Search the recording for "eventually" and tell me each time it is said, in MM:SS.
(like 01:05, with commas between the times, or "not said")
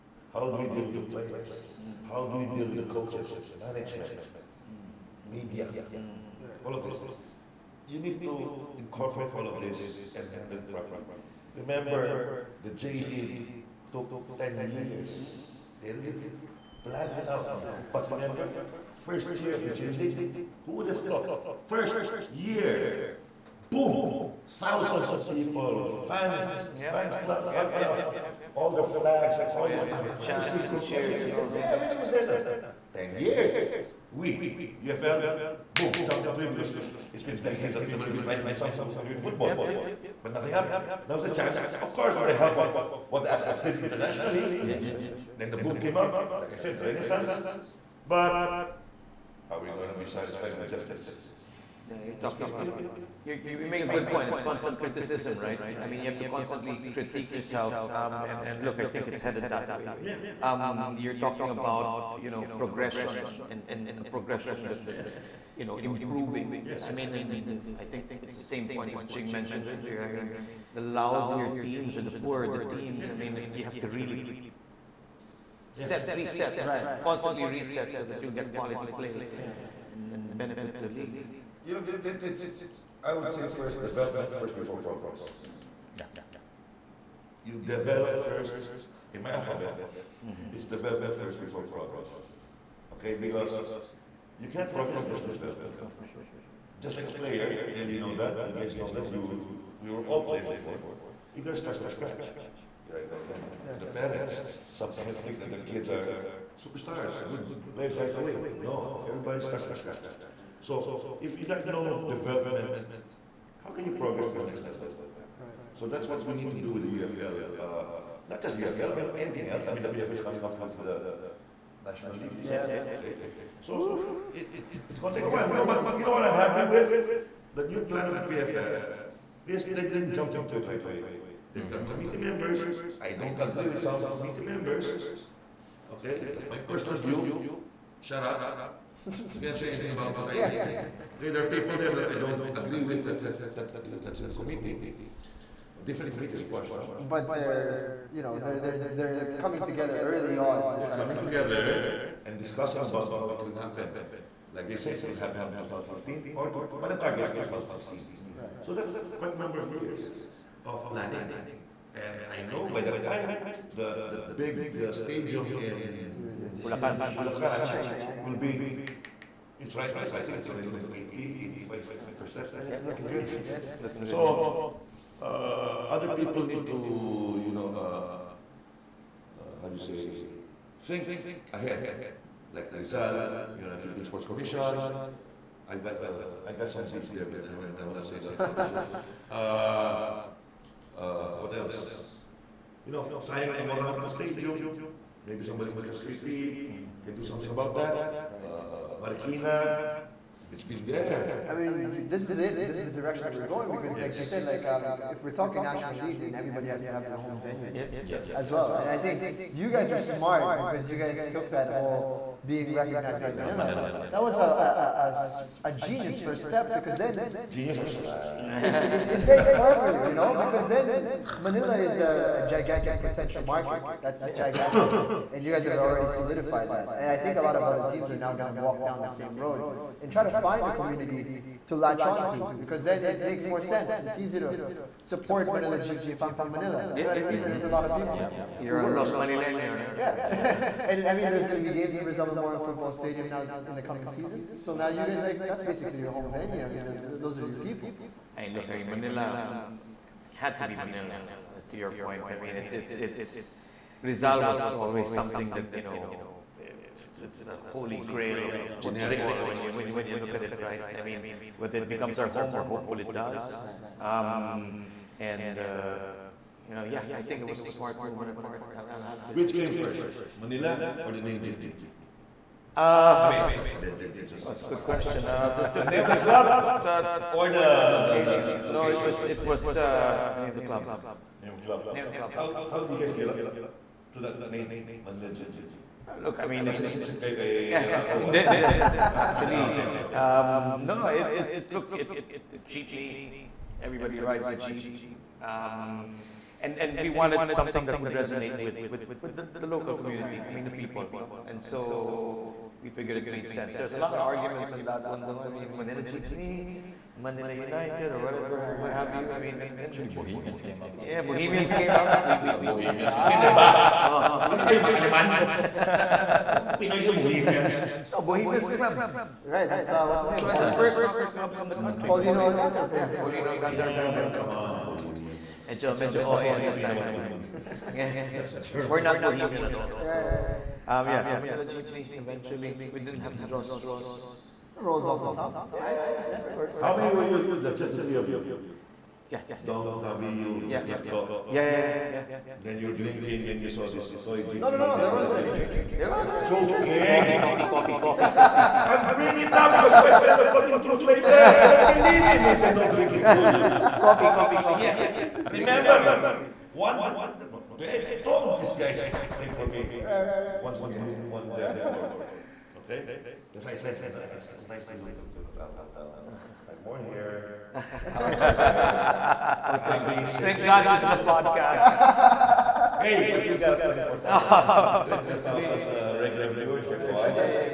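05:32.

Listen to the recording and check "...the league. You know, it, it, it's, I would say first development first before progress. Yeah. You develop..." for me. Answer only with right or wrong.
right.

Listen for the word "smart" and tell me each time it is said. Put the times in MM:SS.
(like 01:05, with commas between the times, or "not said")
03:30, 04:27.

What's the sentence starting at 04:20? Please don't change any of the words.
I mean, whether it becomes our home, We're hopeful it does.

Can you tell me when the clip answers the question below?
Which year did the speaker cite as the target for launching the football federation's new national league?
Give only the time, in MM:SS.
02:37.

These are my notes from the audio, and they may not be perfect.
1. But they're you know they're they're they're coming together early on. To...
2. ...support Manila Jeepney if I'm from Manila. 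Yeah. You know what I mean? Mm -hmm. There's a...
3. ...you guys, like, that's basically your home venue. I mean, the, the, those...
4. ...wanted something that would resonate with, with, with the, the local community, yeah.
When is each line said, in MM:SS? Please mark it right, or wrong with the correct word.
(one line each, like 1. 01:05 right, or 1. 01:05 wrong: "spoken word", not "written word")
1. 02:27 right
2. 03:55 right
3. 04:04 right
4. 04:57 right.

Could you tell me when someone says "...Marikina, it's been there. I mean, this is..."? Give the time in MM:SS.
03:19.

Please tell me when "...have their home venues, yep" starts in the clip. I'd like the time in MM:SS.
03:26.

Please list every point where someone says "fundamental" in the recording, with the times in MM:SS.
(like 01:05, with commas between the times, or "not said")
not said.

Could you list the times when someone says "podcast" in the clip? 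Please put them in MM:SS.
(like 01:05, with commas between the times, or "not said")
06:11.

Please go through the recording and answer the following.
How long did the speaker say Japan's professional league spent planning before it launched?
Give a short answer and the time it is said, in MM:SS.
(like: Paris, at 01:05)
10 years, at 00:14.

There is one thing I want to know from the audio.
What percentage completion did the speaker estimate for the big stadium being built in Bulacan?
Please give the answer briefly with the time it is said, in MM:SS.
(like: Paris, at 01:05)
85%, at 02:52.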